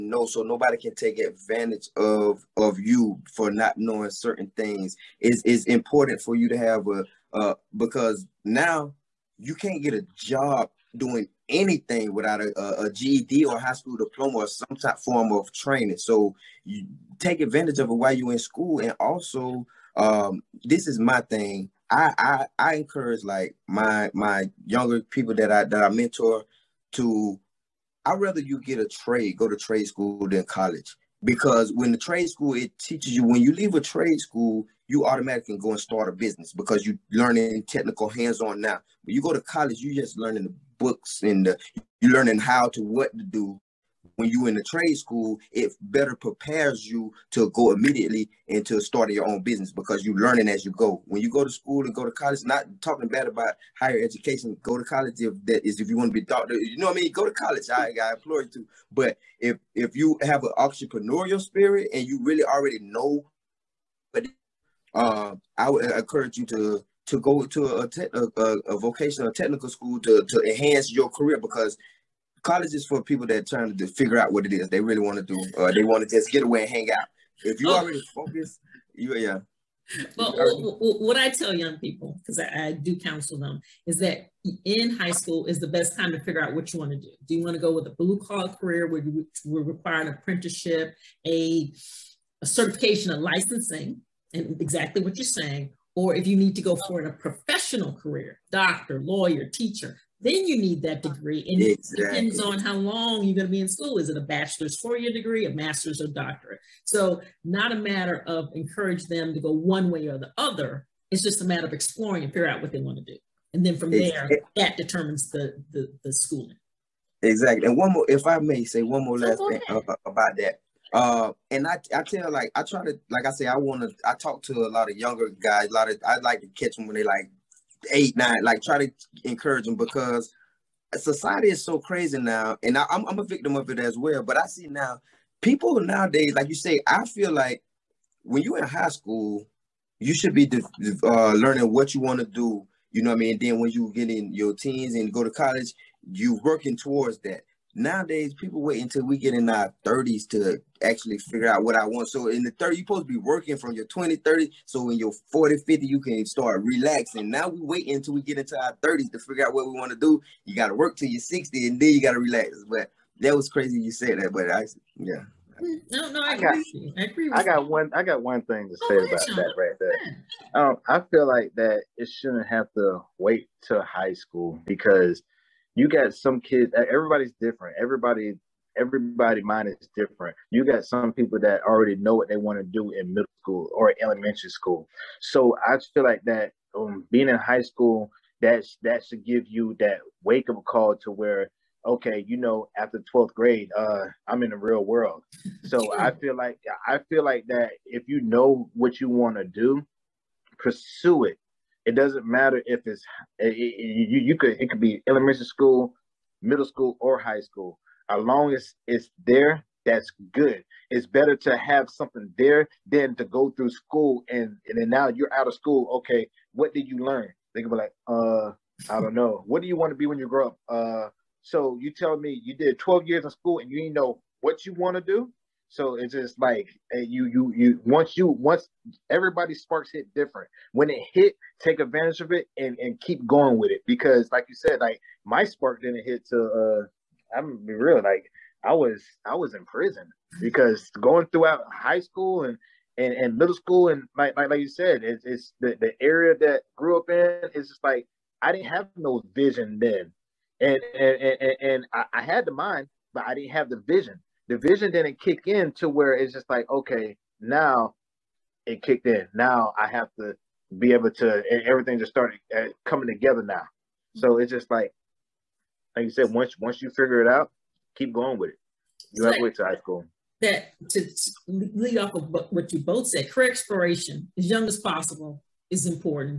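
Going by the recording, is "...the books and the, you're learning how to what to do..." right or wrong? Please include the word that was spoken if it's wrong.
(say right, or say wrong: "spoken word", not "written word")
right.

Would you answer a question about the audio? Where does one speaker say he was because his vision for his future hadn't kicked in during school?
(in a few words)
Prison.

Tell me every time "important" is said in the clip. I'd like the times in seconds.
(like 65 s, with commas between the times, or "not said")
5 s, 275 s.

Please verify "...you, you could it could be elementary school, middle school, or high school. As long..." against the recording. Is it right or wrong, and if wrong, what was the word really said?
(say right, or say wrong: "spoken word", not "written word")
right.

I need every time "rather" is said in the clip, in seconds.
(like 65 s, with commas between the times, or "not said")
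28 s.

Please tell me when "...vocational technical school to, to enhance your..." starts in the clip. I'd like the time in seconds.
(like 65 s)
68 s.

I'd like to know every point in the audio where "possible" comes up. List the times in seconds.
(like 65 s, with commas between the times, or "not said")
274 s.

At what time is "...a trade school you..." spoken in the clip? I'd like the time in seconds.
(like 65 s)
33 s.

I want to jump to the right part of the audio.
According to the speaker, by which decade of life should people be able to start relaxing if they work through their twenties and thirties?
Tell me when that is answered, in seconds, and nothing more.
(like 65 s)
155 s.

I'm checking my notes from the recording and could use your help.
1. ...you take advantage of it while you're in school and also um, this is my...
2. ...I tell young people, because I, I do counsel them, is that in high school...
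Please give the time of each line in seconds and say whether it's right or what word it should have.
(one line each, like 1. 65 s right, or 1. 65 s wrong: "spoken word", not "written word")
1. 16 s right
2. 81 s right.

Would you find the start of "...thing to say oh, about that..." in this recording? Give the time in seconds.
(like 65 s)
168 s.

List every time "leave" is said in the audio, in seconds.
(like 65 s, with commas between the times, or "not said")
33 s.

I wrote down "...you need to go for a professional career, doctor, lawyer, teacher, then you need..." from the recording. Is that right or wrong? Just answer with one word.
right.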